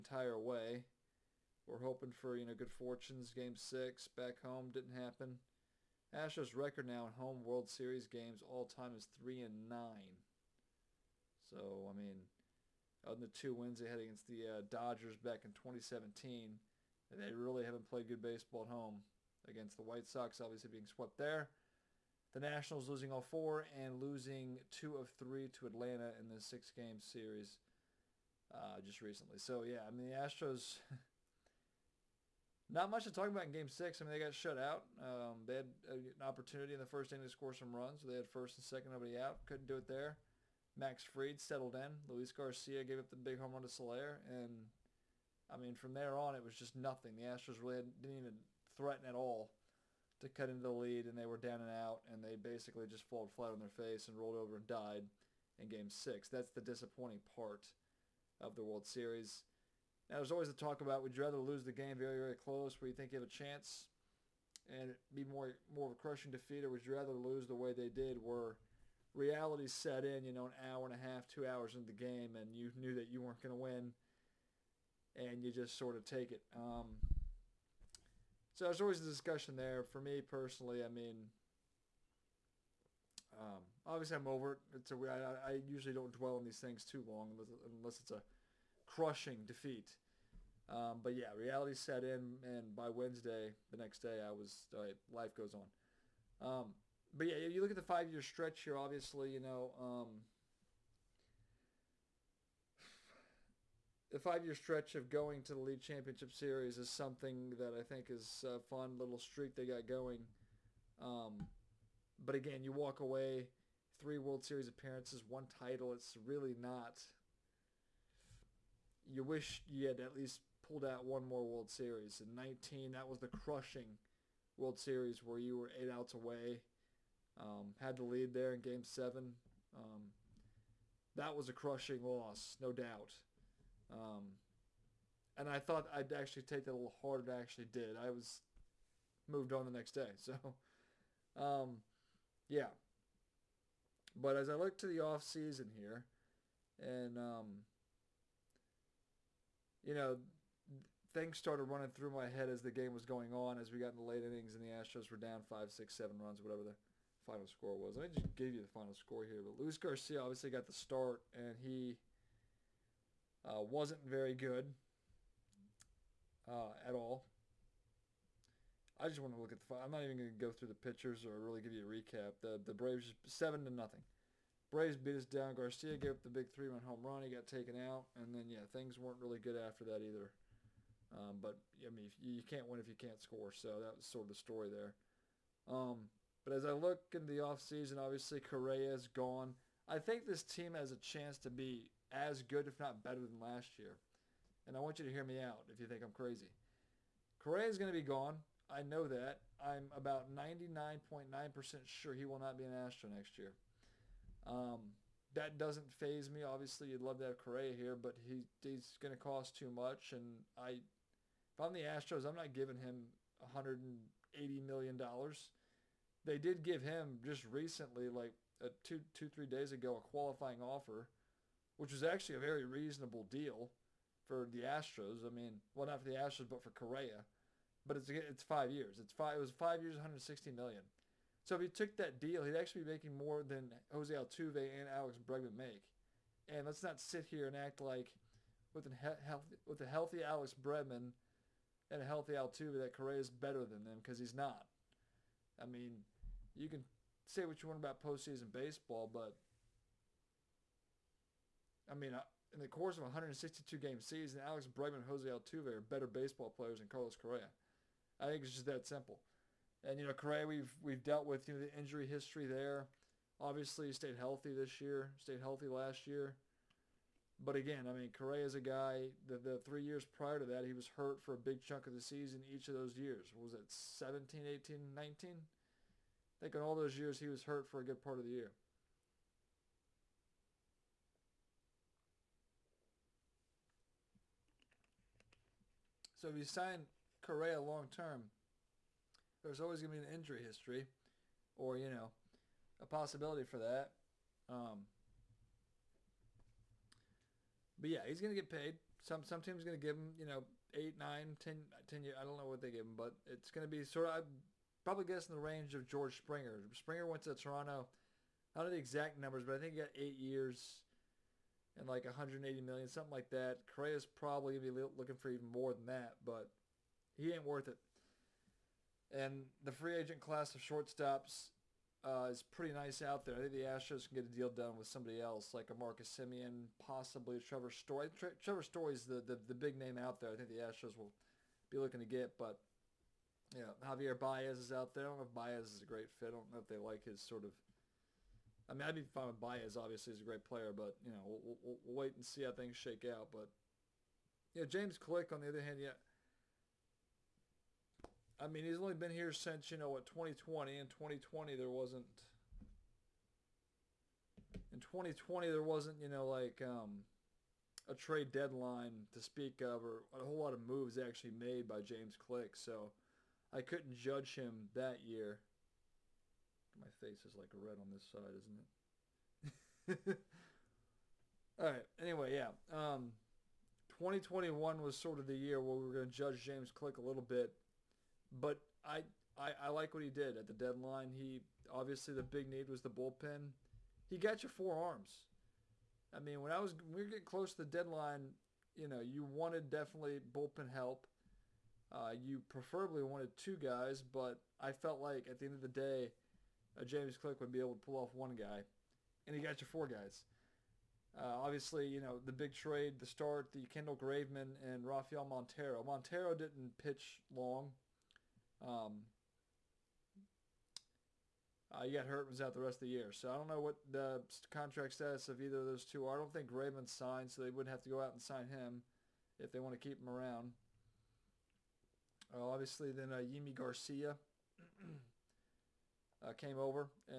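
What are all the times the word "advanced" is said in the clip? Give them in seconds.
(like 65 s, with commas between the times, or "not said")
not said.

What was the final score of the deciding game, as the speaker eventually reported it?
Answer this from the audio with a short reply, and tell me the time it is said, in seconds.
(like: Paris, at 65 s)
7 to 0, at 173 s.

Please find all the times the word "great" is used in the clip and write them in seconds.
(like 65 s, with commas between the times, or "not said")
335 s, 340 s.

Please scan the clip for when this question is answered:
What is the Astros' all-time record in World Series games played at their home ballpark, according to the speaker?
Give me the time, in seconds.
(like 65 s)
9 s.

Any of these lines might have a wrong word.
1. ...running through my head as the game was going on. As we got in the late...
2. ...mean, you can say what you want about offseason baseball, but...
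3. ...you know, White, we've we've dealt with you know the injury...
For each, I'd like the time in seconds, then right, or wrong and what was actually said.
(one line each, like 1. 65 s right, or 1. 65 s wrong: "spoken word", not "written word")
1. 151 s right
2. 245 s wrong: "postseason", not "offseason"
3. 260 s wrong: "Correa", not "White".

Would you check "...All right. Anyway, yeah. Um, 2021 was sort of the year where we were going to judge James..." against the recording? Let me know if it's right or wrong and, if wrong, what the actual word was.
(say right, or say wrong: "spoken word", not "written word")
right.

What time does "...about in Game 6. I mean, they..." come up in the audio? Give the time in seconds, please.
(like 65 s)
33 s.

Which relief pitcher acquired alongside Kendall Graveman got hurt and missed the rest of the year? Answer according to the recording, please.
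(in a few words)
Rafael Montero.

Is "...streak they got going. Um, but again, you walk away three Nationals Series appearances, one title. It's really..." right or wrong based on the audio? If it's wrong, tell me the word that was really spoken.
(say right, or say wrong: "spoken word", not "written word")
wrong: "World", not "Nationals".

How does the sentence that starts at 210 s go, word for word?
And I, if I'm the Astros, I'm not giving him 180 million dollars.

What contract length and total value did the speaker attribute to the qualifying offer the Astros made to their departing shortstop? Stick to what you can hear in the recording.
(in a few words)
5 years, $160 million.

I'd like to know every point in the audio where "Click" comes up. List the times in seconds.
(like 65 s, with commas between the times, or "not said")
344 s, 362 s, 376 s.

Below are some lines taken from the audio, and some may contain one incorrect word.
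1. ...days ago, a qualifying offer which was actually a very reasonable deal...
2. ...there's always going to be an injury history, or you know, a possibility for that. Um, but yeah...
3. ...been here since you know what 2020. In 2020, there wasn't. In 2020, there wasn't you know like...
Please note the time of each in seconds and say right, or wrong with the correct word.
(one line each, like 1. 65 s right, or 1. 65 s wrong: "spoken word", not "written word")
1. 219 s right
2. 289 s right
3. 348 s right.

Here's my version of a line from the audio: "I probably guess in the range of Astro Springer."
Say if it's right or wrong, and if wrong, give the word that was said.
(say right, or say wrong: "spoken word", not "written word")
wrong: "George", not "Astro".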